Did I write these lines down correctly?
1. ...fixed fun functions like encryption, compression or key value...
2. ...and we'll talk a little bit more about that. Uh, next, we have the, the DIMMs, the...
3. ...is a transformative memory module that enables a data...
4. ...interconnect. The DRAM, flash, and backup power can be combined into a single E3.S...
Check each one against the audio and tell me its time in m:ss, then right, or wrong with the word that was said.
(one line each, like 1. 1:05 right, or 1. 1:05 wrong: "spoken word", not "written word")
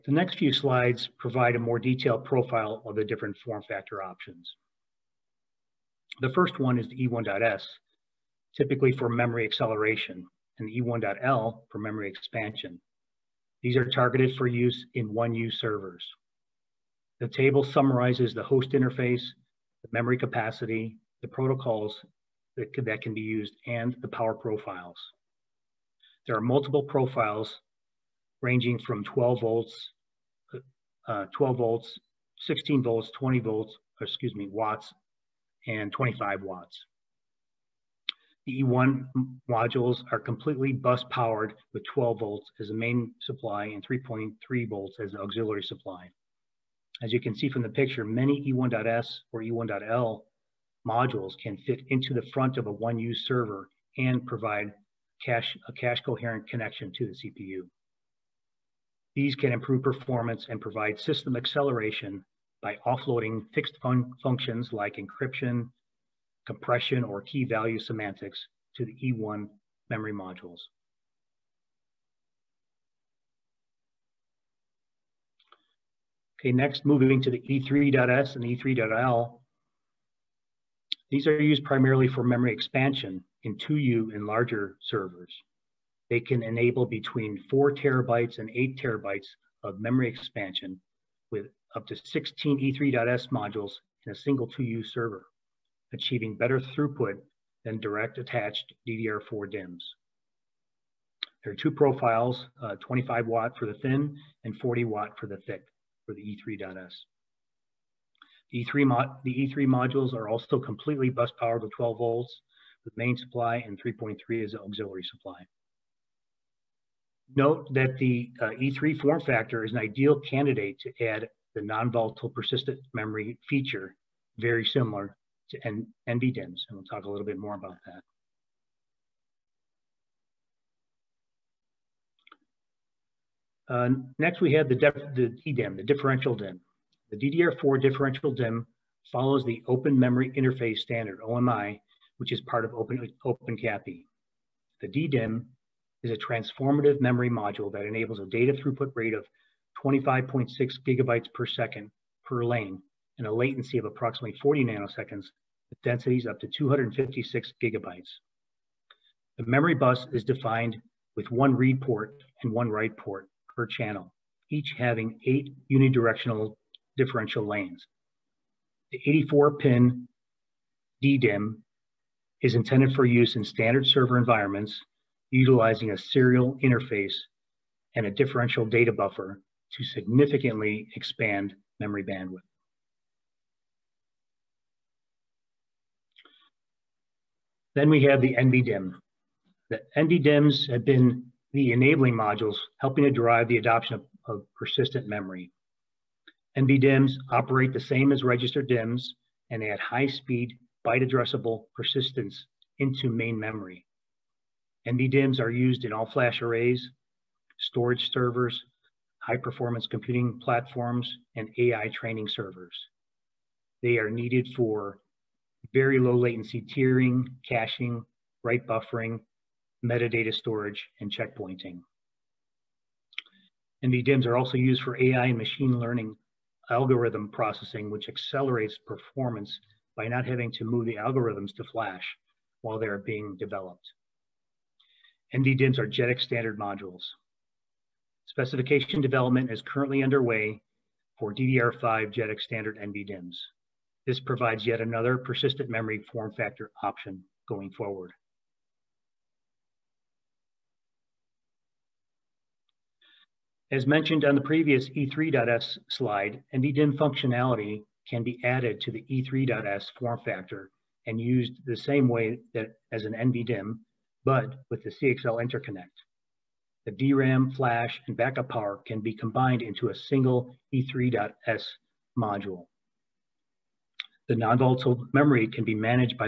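1. 1:03 right
2. 2:06 wrong: "DDIMM", not "DIMMs"
3. 2:26 right
4. 4:25 right.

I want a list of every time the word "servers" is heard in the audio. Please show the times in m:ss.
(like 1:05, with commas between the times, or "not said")
0:15, 0:53, 1:24, 1:34, 2:53, 3:28, 3:32.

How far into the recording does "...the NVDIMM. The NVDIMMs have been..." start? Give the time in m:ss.
3:08.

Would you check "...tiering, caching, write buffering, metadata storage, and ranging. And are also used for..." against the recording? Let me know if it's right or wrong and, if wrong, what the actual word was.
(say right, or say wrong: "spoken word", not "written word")
wrong: "checkpointing", not "ranging".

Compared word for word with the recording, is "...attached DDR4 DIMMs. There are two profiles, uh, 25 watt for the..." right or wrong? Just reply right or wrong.
right.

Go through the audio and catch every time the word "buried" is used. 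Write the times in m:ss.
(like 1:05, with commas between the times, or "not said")
not said.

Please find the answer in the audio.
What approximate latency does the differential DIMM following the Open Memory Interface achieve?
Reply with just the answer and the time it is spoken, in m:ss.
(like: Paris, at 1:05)
40 nanoseconds, at 2:34.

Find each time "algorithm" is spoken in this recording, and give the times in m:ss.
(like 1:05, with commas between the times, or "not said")
3:46, 3:50.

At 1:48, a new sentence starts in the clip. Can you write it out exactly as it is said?
The E3, the E3 modules are also completely bus powered with 12 volts with main supply and 3.3 as auxiliary supply.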